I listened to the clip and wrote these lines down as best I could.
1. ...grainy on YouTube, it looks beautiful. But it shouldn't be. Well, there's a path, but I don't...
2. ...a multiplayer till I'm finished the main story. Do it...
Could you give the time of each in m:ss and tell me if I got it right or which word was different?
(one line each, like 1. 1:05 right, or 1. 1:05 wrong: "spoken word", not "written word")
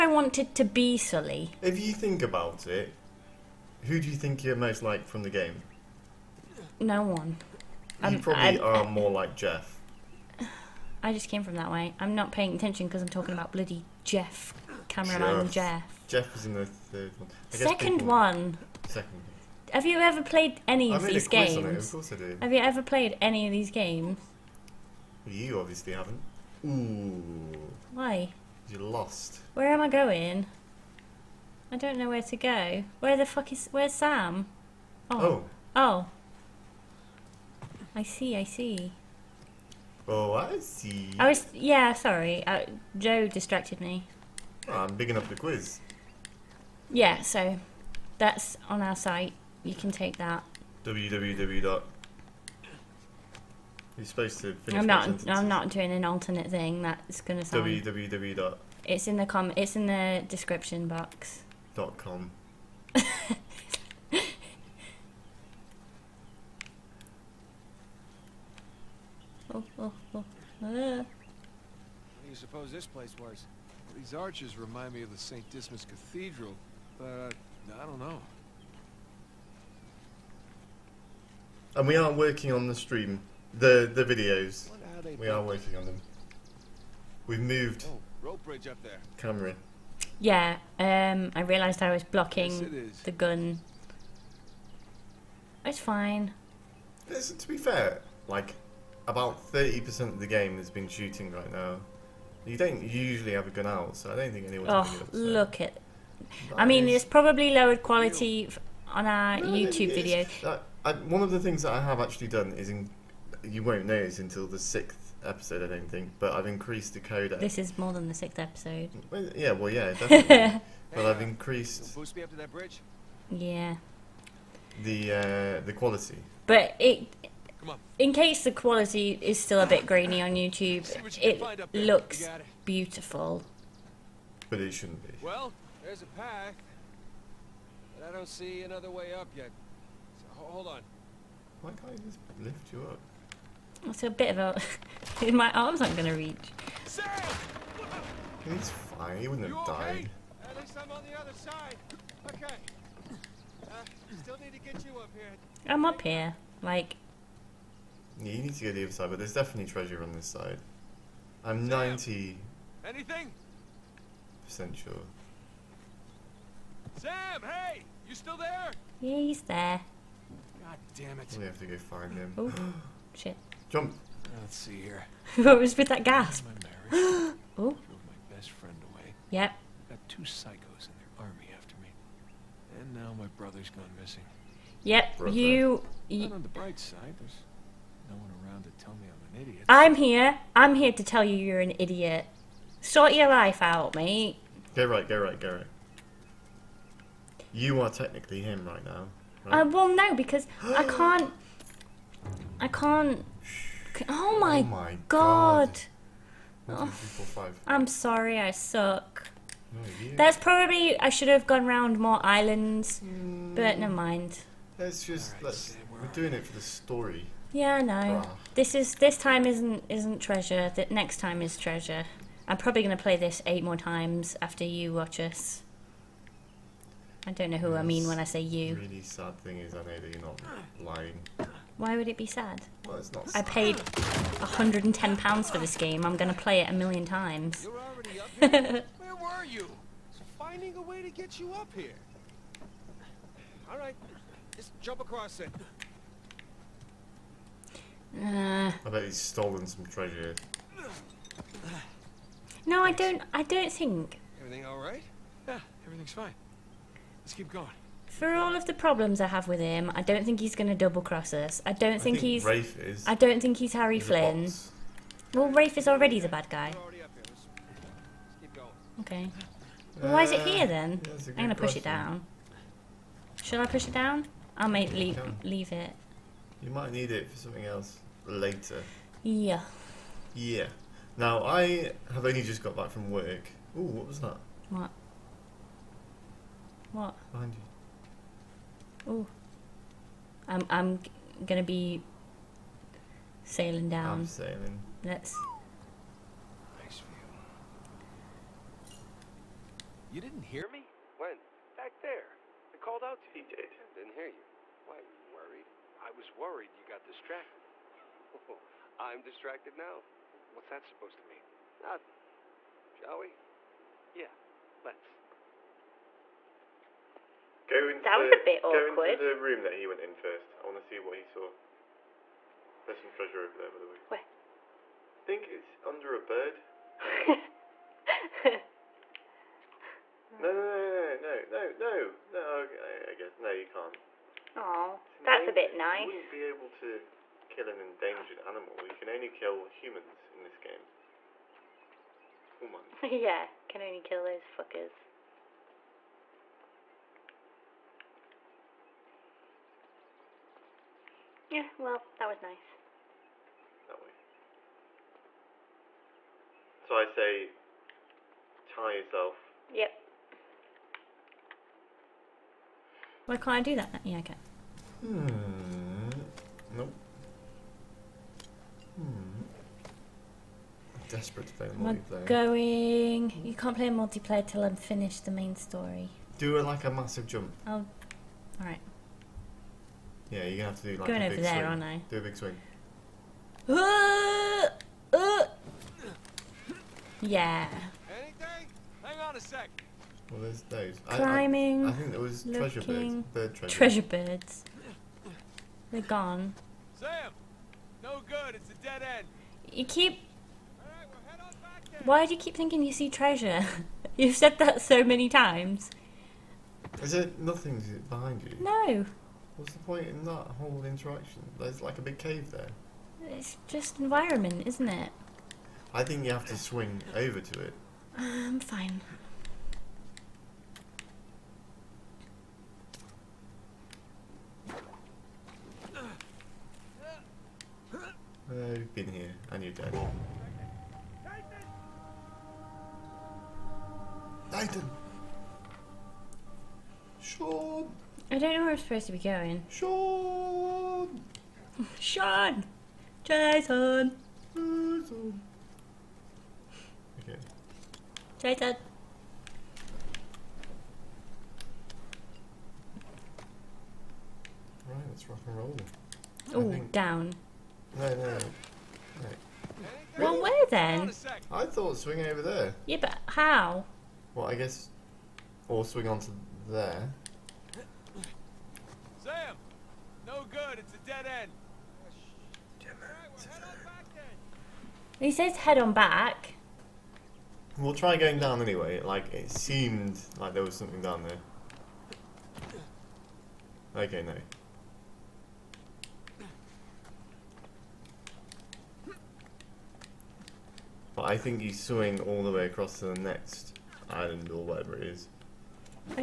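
1. 2:09 right
2. 6:13 right.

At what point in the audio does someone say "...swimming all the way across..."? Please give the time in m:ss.
8:11.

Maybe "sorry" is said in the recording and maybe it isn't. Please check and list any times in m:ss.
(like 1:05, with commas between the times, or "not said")
0:41, 3:27.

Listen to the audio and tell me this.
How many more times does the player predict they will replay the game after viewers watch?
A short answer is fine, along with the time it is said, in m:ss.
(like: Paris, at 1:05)
8, at 3:43.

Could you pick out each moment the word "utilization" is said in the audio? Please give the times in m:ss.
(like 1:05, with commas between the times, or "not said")
not said.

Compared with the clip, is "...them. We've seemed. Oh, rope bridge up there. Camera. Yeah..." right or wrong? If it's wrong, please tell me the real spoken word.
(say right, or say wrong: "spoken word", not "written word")
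wrong: "moved", not "seemed".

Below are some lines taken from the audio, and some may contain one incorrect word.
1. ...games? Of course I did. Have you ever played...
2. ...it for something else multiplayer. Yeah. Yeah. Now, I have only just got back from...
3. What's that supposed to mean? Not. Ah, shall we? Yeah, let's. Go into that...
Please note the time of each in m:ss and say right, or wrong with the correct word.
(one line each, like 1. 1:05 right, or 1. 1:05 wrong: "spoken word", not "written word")
1. 0:21 right
2. 4:37 wrong: "later", not "multiplayer"
3. 5:10 right.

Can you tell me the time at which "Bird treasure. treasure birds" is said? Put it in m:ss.
6:33.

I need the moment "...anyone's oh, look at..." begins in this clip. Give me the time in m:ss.
1:44.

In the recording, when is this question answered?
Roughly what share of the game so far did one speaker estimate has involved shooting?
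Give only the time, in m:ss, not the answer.
1:39.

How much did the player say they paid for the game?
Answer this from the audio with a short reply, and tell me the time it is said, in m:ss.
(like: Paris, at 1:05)
110 pounds, at 3:54.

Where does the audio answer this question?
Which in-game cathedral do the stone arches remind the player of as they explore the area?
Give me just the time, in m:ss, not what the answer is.
1:15.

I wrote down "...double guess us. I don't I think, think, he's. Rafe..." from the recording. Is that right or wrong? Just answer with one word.
wrong.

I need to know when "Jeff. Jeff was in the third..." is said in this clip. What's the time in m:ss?
0:15.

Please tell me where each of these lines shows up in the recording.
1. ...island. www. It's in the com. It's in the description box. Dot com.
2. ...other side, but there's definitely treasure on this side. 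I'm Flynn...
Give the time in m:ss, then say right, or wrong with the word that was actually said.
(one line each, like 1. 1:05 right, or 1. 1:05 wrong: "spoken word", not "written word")
1. 0:57 wrong: "sound", not "island"
2. 2:38 wrong: "Sam", not "Flynn".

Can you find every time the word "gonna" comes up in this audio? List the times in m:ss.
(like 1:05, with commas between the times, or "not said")
0:57, 2:25, 4:31, 4:51, 6:20.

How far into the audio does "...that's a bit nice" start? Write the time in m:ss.
5:35.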